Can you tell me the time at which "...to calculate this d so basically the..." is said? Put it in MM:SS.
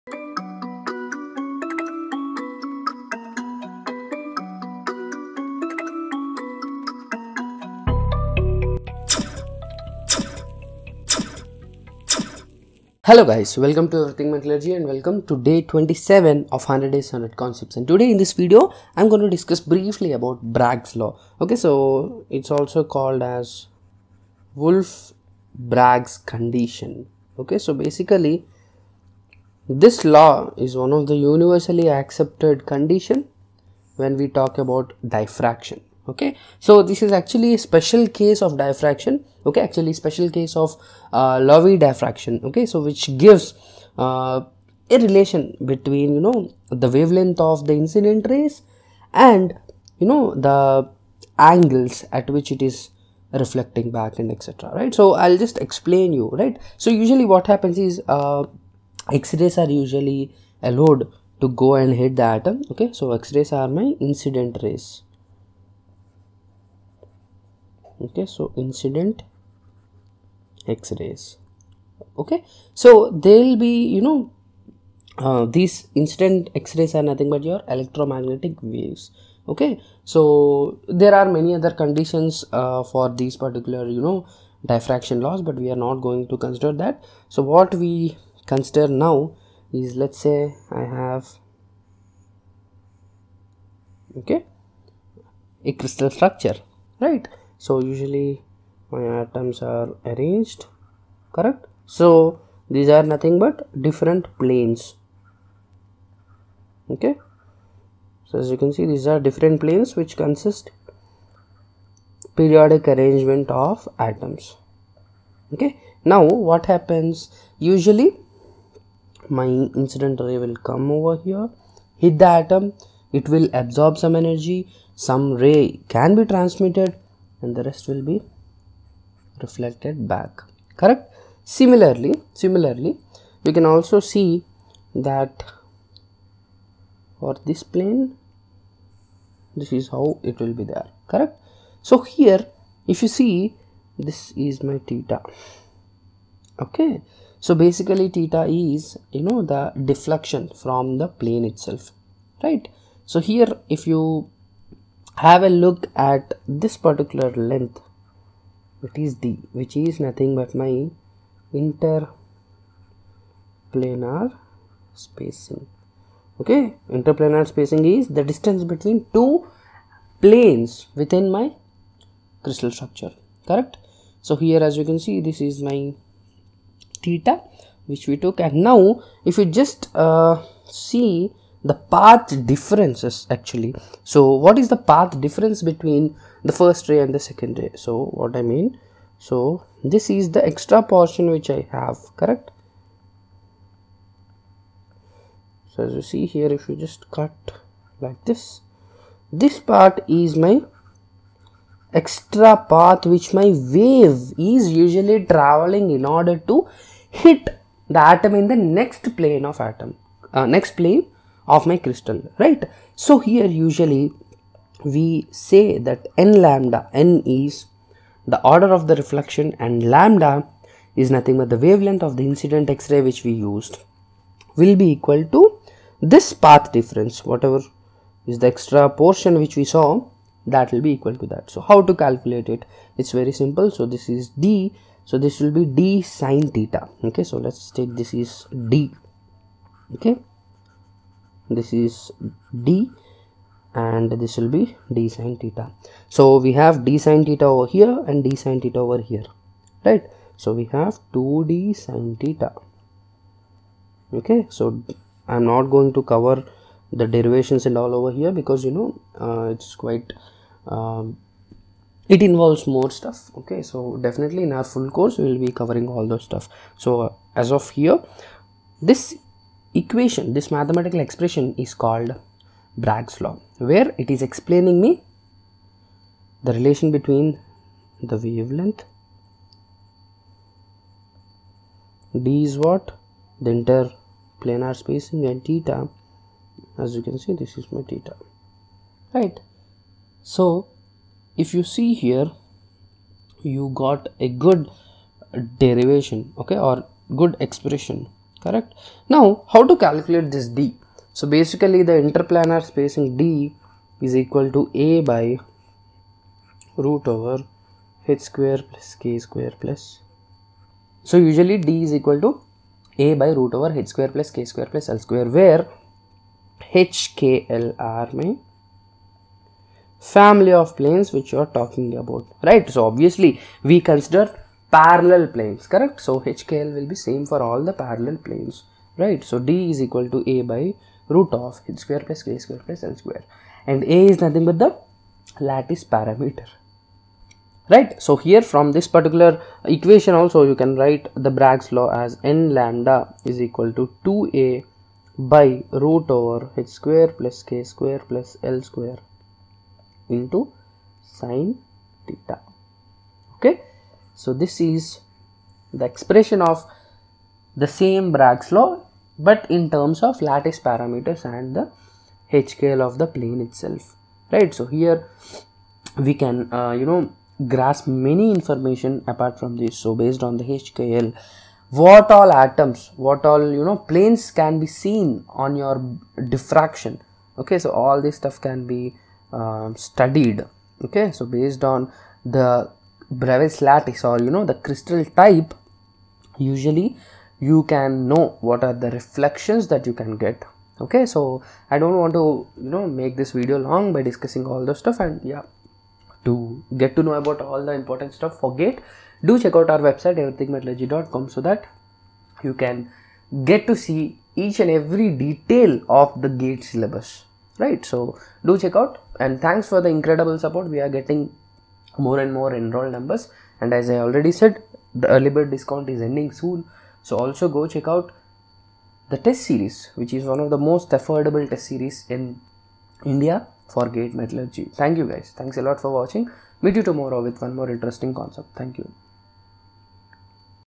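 04:59.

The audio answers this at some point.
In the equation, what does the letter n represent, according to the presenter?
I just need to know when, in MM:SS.
03:38.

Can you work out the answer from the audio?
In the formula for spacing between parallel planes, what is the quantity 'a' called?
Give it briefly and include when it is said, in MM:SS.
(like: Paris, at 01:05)
lattice parameter, at 05:35.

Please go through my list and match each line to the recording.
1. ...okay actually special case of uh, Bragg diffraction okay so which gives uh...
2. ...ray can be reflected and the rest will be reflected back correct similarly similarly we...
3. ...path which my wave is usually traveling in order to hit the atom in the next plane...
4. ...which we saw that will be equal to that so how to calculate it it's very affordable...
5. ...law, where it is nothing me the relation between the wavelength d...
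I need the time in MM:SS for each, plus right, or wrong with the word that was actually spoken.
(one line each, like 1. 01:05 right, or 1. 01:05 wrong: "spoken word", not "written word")
1. 00:39 wrong: "Laue", not "Bragg"
2. 02:05 wrong: "transmitted", not "reflected"
3. 03:22 right
4. 03:49 wrong: "simple", not "affordable"
5. 04:33 wrong: "explaining", not "nothing".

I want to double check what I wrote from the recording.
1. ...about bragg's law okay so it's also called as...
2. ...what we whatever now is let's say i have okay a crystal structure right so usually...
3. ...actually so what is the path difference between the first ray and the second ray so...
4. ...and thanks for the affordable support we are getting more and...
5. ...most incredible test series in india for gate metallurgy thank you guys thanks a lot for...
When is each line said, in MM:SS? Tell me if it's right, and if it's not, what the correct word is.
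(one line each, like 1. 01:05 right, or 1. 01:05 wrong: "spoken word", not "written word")
1. 00:20 right
2. 01:27 wrong: "consider", not "whatever"
3. 03:03 right
4. 06:49 wrong: "incredible", not "affordable"
5. 07:00 wrong: "affordable", not "incredible".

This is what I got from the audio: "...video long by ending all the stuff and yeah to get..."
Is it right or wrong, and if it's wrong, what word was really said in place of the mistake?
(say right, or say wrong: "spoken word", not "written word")
wrong: "discussing", not "ending".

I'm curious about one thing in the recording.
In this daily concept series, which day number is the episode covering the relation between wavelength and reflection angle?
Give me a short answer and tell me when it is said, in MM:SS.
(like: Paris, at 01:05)
27, at 00:15.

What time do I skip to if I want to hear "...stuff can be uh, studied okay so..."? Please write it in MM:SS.
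06:18.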